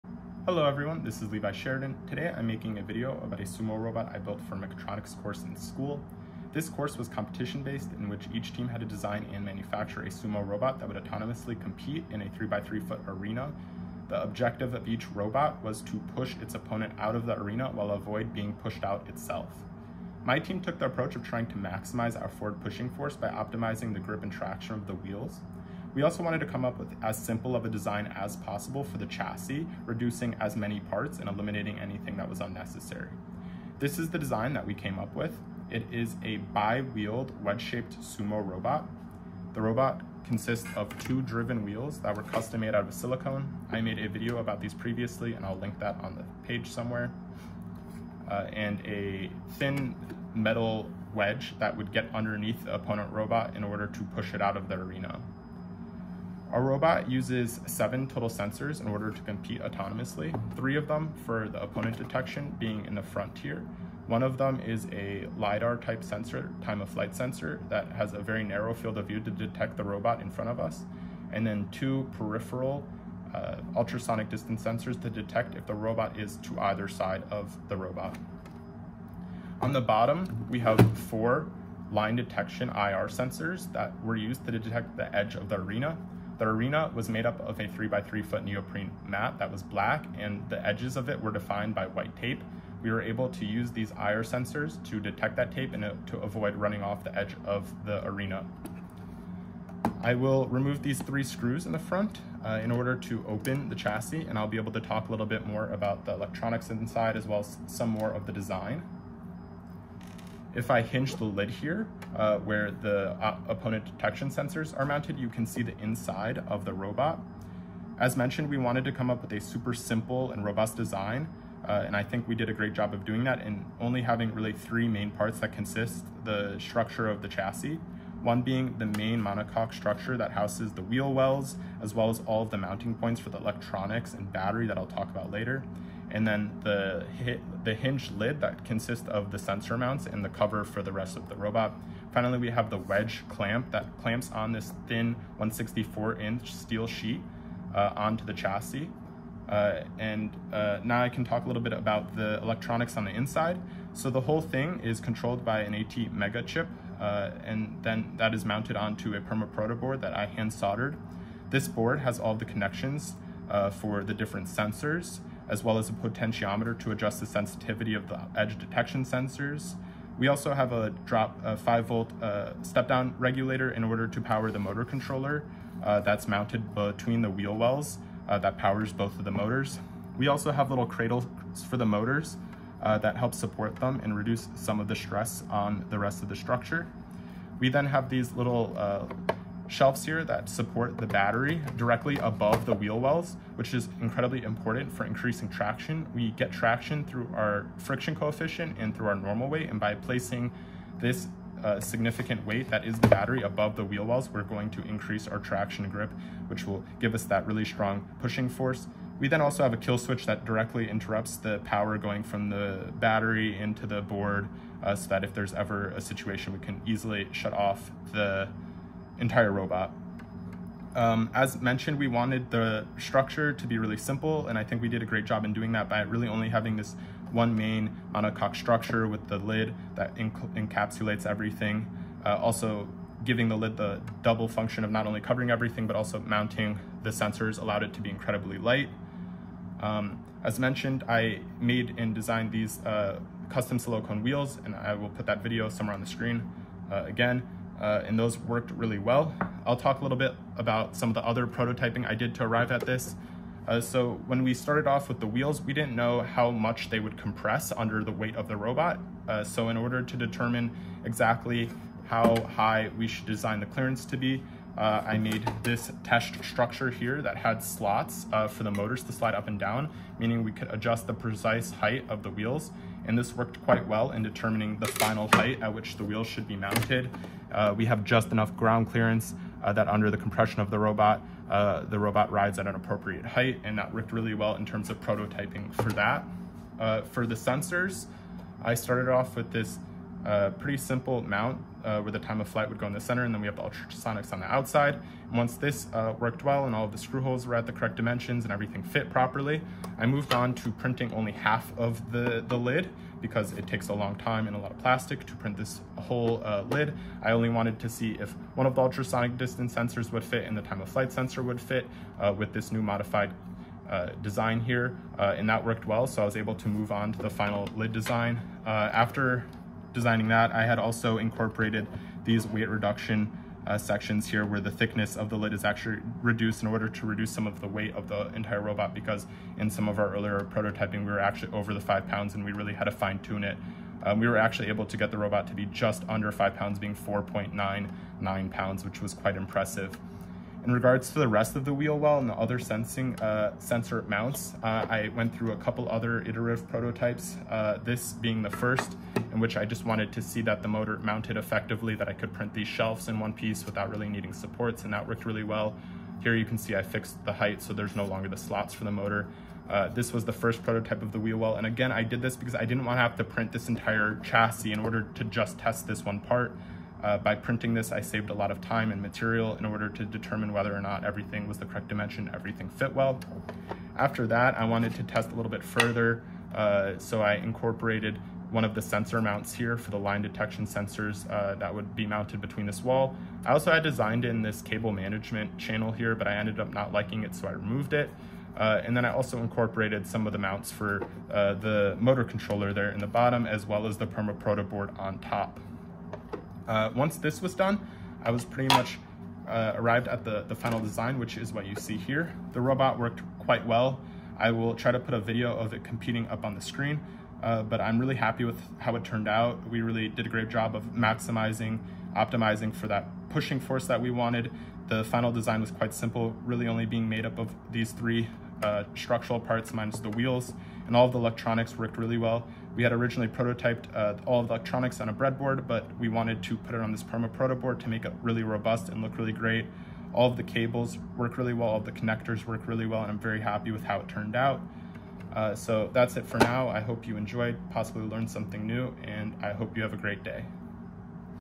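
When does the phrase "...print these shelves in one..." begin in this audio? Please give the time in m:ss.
5:52.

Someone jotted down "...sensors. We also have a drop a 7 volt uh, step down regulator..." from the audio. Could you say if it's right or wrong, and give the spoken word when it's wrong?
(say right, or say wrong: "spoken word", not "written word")
wrong: "5", not "7".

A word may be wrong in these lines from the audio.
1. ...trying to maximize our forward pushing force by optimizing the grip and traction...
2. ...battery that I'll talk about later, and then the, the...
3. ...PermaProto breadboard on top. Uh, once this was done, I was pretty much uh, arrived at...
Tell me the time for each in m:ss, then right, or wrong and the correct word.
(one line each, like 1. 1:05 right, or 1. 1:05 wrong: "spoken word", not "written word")
1. 0:21 right
2. 2:14 right
3. 6:34 wrong: "board", not "breadboard".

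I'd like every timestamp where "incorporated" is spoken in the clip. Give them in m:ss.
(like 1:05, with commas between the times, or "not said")
5:21, 6:17, 6:29.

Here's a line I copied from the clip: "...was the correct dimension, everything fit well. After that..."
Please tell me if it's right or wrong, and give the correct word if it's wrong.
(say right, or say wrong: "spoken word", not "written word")
right.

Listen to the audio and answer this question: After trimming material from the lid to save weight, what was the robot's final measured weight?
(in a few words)
4.99 pounds.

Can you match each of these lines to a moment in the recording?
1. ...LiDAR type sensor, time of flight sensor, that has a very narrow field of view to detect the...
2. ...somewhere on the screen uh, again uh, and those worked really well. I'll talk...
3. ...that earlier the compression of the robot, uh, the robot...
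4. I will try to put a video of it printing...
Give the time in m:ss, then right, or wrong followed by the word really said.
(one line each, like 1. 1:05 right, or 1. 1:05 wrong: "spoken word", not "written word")
1. 1:05 right
2. 4:05 right
3. 4:39 wrong: "under", not "earlier"
4. 6:44 wrong: "competing", not "printing".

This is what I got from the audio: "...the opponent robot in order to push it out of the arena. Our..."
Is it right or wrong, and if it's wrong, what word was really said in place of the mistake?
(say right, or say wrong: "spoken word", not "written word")
right.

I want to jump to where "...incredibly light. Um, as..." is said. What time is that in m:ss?
3:58.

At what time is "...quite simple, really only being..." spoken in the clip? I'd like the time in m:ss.
6:55.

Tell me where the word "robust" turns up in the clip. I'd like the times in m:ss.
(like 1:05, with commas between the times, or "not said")
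2:00, 7:08.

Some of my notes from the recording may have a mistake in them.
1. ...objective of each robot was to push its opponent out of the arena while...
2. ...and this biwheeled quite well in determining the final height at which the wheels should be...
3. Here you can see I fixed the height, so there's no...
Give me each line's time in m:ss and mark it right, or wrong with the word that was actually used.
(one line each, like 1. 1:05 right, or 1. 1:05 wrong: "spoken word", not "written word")
1. 0:14 right
2. 4:33 wrong: "worked", not "biwheeled"
3. 5:56 right.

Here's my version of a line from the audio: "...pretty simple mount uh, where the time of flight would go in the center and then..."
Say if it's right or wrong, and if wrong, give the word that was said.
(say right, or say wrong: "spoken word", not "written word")
right.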